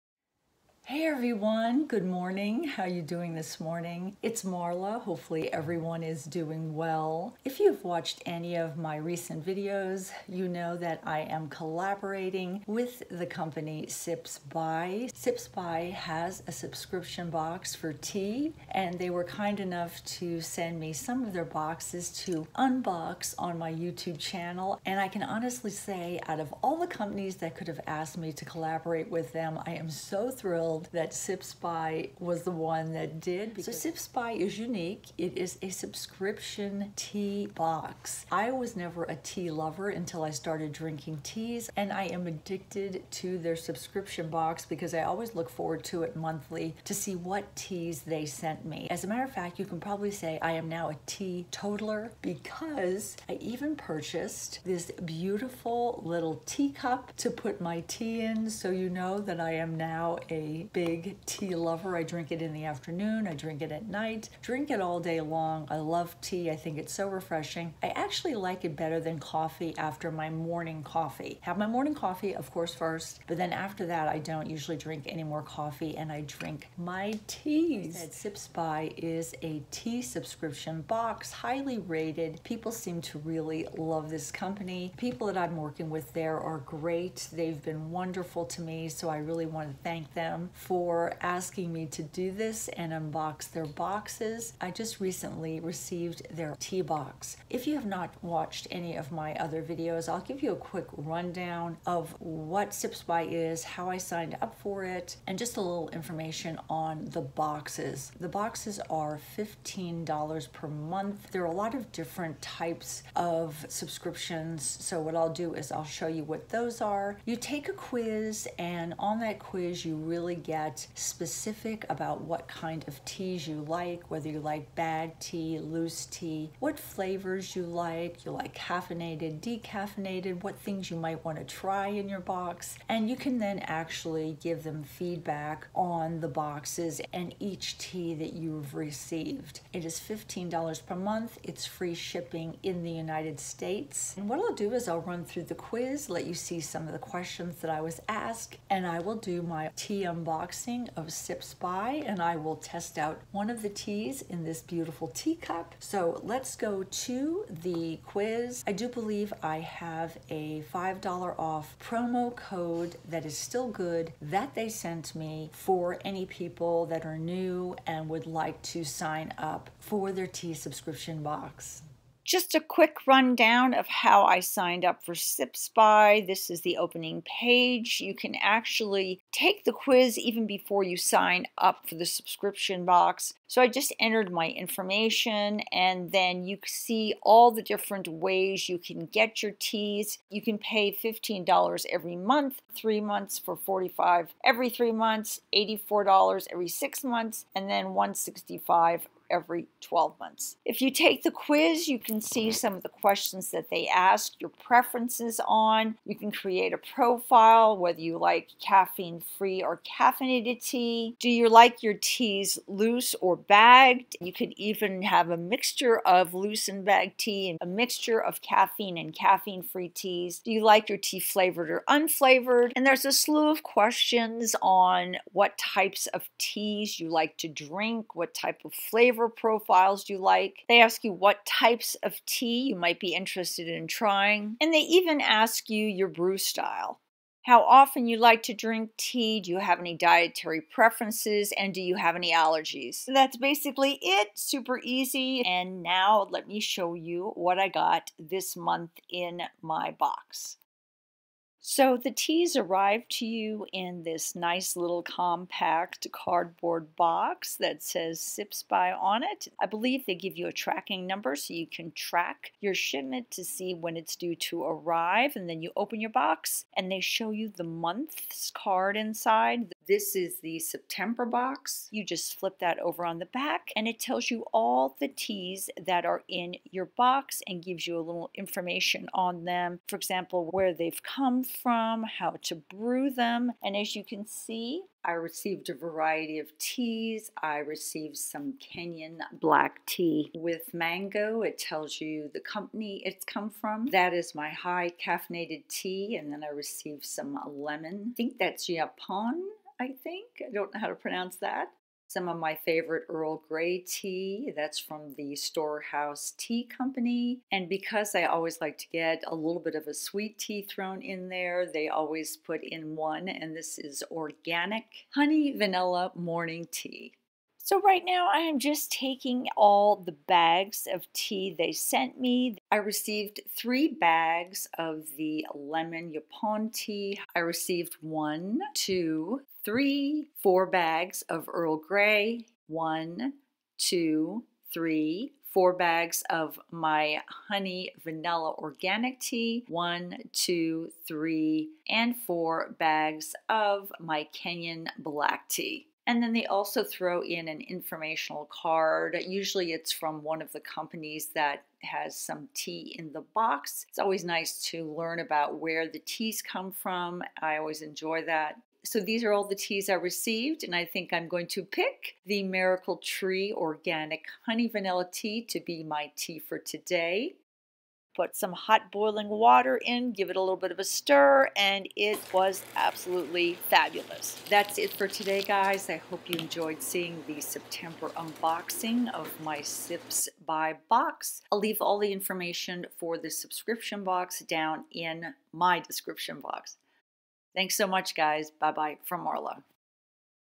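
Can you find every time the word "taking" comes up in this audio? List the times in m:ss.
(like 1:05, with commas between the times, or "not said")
5:18.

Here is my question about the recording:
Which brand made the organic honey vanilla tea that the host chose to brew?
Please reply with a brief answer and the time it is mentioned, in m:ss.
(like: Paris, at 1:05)
Miracle Tree, at 6:02.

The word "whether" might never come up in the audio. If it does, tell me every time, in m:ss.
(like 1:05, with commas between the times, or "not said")
2:04, 3:27.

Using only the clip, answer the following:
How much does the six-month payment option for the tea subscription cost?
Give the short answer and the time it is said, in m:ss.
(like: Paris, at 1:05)
$84, at 3:15.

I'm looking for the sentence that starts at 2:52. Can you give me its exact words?
Just a quick rundown of how I signed up for Sips By.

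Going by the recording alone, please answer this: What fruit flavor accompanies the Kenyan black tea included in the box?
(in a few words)
Mango.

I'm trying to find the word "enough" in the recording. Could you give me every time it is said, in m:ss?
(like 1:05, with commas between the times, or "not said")
0:19.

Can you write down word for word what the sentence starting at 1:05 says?
I love tea, I think it's so refreshing.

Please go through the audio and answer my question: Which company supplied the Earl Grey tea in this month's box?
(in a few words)
Storehouse Tea Company.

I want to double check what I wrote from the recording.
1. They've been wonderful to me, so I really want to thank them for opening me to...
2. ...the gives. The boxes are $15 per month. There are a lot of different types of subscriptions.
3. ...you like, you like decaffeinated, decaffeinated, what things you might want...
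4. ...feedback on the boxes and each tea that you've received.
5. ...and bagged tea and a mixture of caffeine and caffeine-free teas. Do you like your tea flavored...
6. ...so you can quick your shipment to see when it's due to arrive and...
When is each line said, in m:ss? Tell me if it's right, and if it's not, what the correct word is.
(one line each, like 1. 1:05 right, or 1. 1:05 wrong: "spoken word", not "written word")
1. 1:27 wrong: "asking", not "opening"
2. 1:47 wrong: "boxes", not "gives"
3. 2:07 wrong: "caffeinated", not "decaffeinated"
4. 2:14 right
5. 3:36 right
6. 4:21 wrong: "track", not "quick".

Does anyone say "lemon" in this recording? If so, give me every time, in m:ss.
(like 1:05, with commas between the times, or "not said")
4:57, 5:25.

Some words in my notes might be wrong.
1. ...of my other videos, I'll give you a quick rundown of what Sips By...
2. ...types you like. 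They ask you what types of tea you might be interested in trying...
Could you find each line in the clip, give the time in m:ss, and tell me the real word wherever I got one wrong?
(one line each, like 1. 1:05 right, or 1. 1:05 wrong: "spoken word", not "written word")
1. 1:38 right
2. 3:49 wrong: "profiles", not "types".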